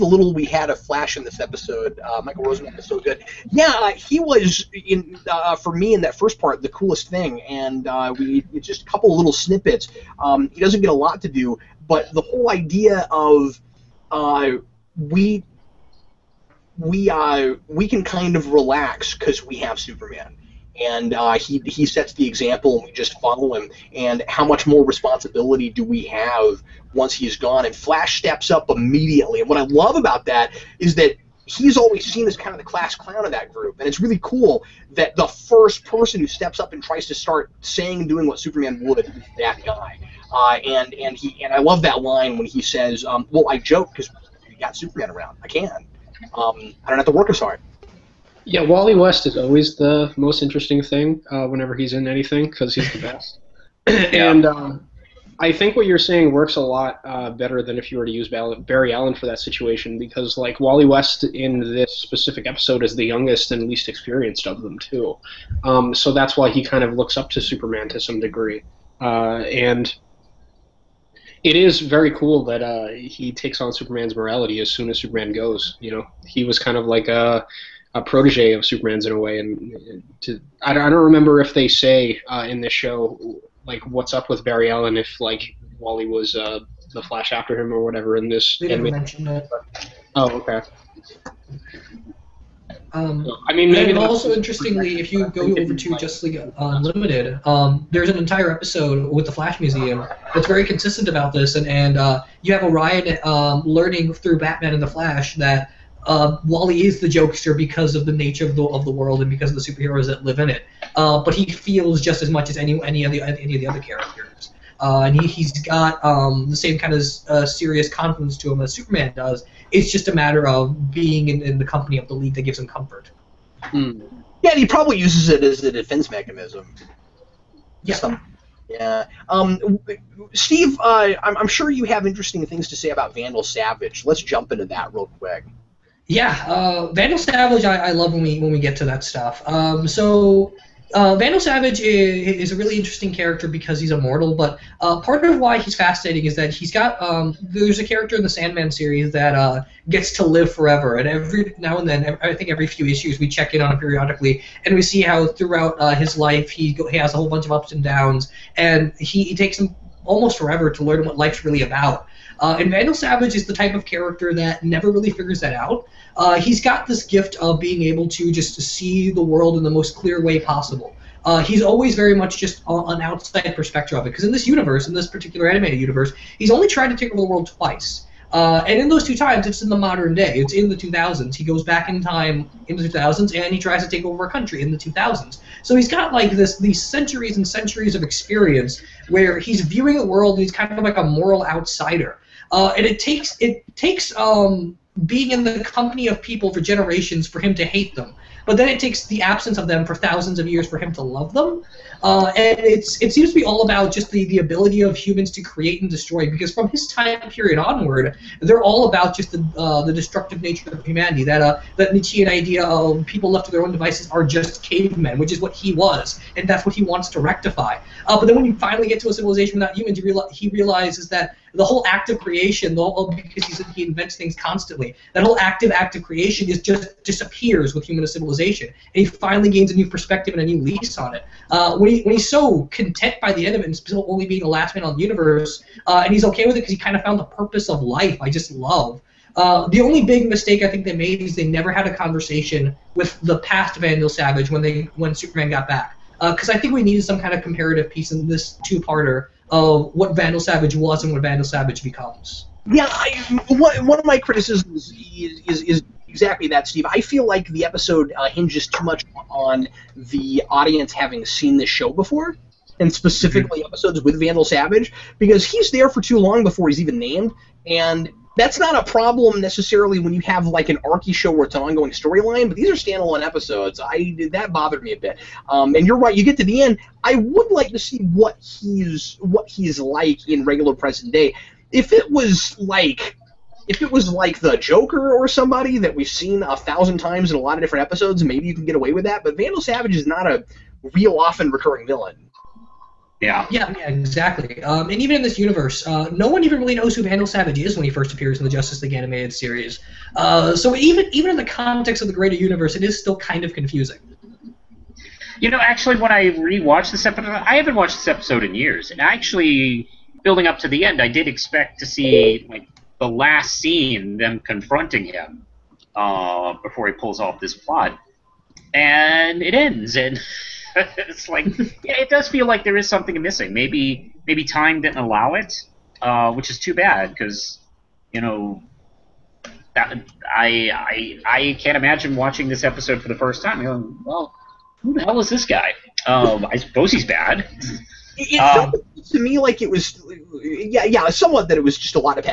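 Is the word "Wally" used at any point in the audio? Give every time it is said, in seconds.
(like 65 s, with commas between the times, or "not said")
48 s, 60 s, 85 s, 106 s.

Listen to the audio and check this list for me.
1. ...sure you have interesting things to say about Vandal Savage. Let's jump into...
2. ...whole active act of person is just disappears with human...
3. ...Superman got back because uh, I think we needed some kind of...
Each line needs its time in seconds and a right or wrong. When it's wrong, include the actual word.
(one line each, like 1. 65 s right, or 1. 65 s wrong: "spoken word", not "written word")
1. 131 s right
2. 225 s wrong: "creation", not "person"
3. 245 s right.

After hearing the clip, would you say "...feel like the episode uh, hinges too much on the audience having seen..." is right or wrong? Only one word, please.
right.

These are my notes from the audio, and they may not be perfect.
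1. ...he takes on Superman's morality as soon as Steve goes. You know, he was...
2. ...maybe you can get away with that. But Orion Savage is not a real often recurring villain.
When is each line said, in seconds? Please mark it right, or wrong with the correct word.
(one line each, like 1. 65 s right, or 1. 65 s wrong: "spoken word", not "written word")
1. 72 s wrong: "Superman", not "Steve"
2. 288 s wrong: "Vandal", not "Orion".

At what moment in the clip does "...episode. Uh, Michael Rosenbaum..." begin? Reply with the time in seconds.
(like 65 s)
1 s.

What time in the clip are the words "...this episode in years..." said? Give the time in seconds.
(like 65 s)
307 s.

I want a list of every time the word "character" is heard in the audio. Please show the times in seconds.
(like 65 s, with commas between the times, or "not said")
113 s, 143 s, 147 s, 163 s.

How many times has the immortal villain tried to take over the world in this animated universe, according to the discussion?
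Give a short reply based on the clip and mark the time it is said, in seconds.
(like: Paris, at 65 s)
2, at 177 s.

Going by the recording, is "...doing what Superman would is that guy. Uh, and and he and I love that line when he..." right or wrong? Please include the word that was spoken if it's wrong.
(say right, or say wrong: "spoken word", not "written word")
right.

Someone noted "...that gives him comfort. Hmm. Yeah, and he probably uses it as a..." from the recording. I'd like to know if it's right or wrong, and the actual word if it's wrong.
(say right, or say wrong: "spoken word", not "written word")
right.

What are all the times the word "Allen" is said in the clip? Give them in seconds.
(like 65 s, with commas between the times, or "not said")
58 s, 84 s.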